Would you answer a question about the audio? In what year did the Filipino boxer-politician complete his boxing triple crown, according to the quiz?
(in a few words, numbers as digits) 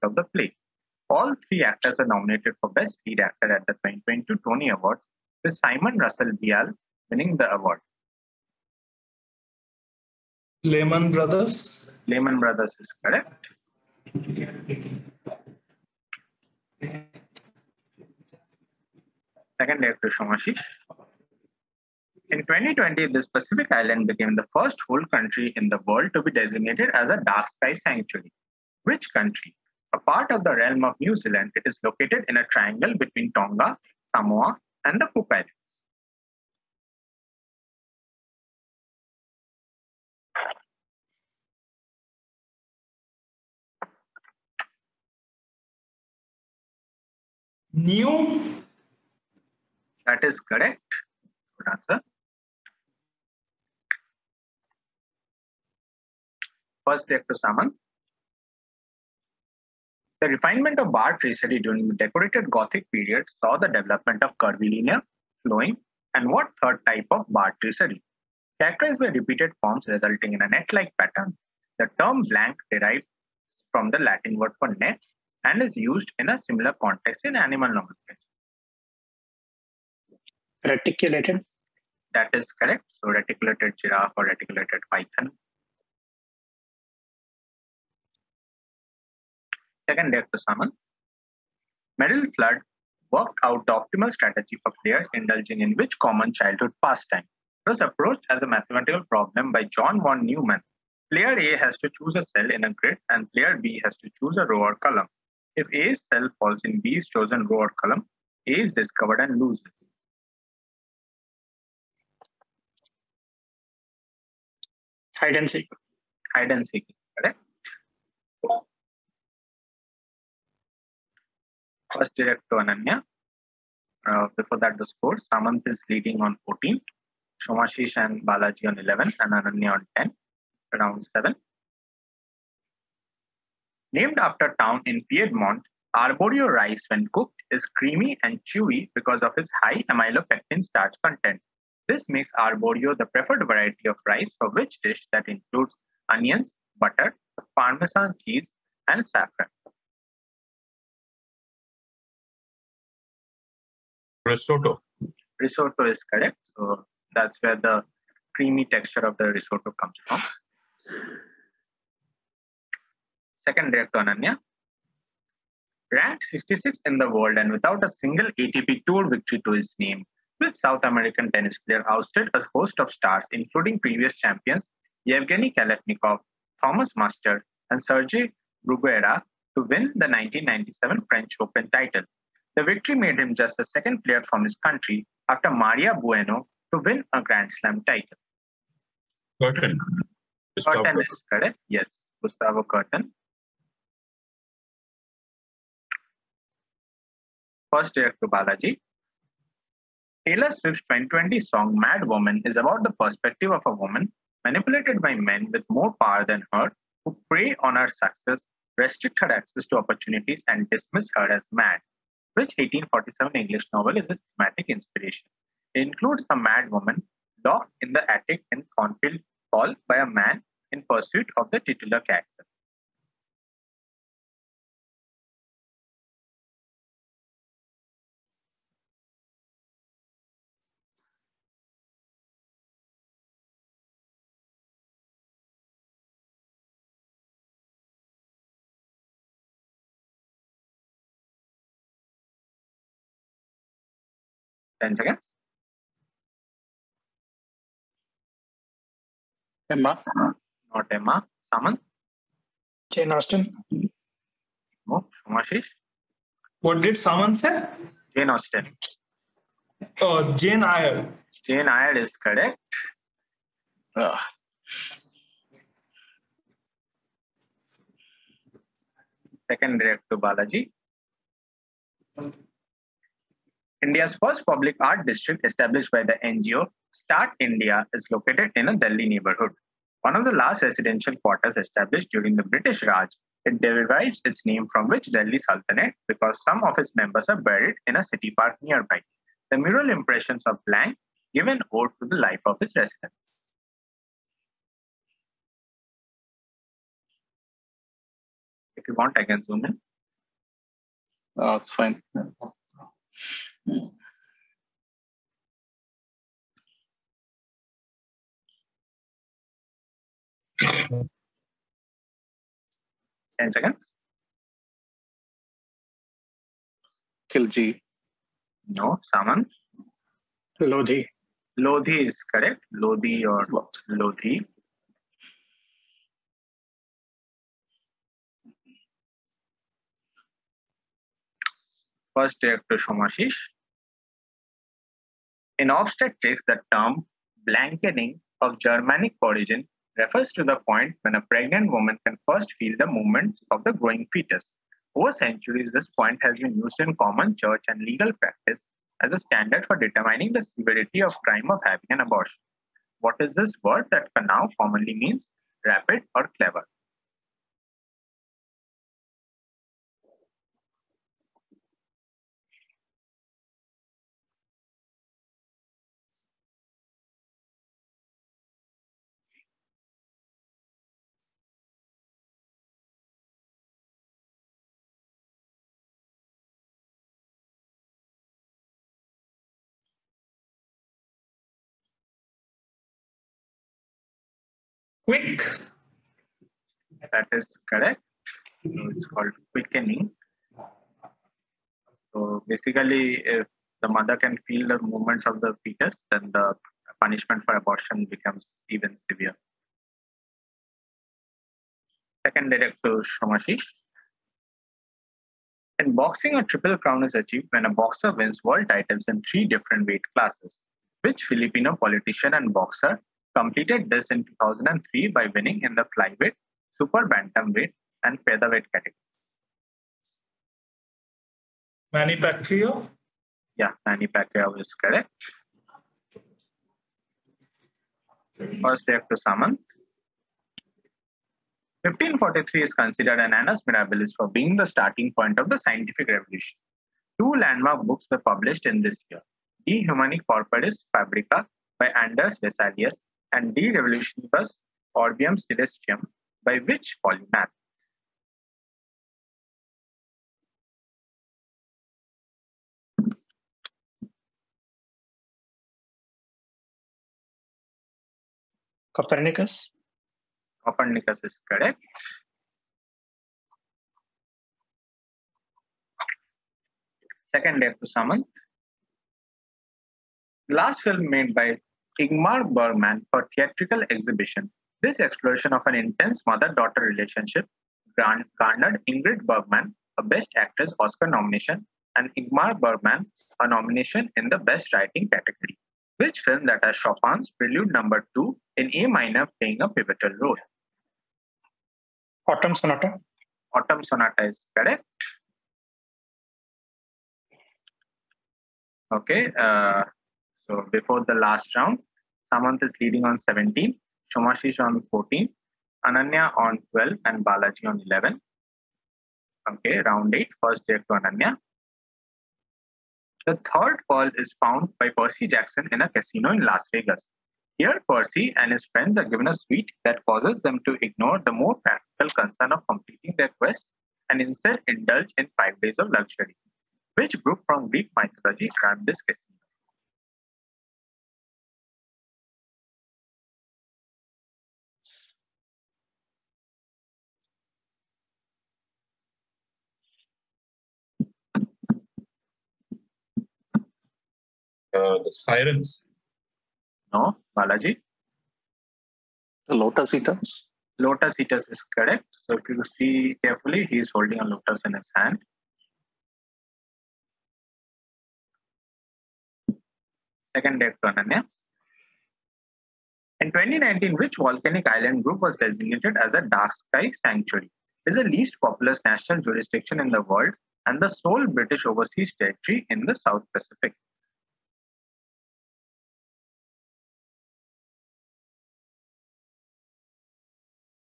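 2003.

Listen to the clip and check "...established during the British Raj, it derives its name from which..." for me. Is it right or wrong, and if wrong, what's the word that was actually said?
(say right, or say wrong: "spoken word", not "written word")
right.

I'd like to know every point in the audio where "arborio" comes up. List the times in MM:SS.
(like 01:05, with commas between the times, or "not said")
02:16, 02:22.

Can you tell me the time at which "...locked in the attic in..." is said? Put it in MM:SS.
03:37.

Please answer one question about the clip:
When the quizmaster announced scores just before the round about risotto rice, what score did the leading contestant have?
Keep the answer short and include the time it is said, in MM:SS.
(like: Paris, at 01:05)
14, at 02:05.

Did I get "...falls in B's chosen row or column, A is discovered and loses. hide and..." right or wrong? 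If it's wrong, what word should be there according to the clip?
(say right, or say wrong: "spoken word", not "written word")
right.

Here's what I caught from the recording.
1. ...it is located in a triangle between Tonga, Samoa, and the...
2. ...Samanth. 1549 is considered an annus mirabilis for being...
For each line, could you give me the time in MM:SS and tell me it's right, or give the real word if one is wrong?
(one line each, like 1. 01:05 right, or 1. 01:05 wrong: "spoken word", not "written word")
1. 00:31 right
2. 07:09 wrong: "1543", not "1549".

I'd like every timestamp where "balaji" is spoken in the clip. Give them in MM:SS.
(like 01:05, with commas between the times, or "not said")
02:08, 03:18, 04:30, 08:27, 09:07.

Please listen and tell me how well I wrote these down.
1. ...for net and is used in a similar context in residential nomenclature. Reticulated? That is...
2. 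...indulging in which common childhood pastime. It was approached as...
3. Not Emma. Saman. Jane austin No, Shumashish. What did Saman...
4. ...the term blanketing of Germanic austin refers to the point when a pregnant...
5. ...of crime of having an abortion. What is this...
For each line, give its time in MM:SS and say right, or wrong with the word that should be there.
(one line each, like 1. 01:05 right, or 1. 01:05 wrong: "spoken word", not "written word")
1. 01:14 wrong: "animal", not "residential"
2. 01:35 right
3. 04:10 right
4. 05:36 wrong: "origin", not "austin"
5. 05:51 right.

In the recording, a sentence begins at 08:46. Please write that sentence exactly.
Which group from Greek mythology ran this casino?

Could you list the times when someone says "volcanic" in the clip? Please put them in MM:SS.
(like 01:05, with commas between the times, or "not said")
09:24.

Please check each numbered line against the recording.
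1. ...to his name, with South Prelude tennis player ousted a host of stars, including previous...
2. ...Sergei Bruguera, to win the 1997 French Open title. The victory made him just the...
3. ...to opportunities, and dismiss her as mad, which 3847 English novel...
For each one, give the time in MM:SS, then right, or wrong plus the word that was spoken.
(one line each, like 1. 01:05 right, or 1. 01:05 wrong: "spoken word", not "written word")
1. 02:49 wrong: "American", not "Prelude"
2. 02:57 right
3. 03:29 wrong: "1847", not "3847".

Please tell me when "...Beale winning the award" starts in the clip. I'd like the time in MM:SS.
00:06.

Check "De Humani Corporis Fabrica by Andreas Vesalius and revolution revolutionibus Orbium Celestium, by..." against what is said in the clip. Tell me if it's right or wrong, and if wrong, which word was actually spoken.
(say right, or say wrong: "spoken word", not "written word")
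right.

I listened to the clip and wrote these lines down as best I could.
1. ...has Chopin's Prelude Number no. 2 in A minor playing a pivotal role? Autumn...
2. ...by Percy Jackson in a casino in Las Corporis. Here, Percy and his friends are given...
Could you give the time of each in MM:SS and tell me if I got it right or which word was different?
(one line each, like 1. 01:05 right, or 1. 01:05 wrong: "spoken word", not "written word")
1. 08:06 right
2. 08:34 wrong: "Vegas", not "Corporis".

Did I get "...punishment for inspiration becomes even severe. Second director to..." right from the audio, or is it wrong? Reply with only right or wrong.
wrong.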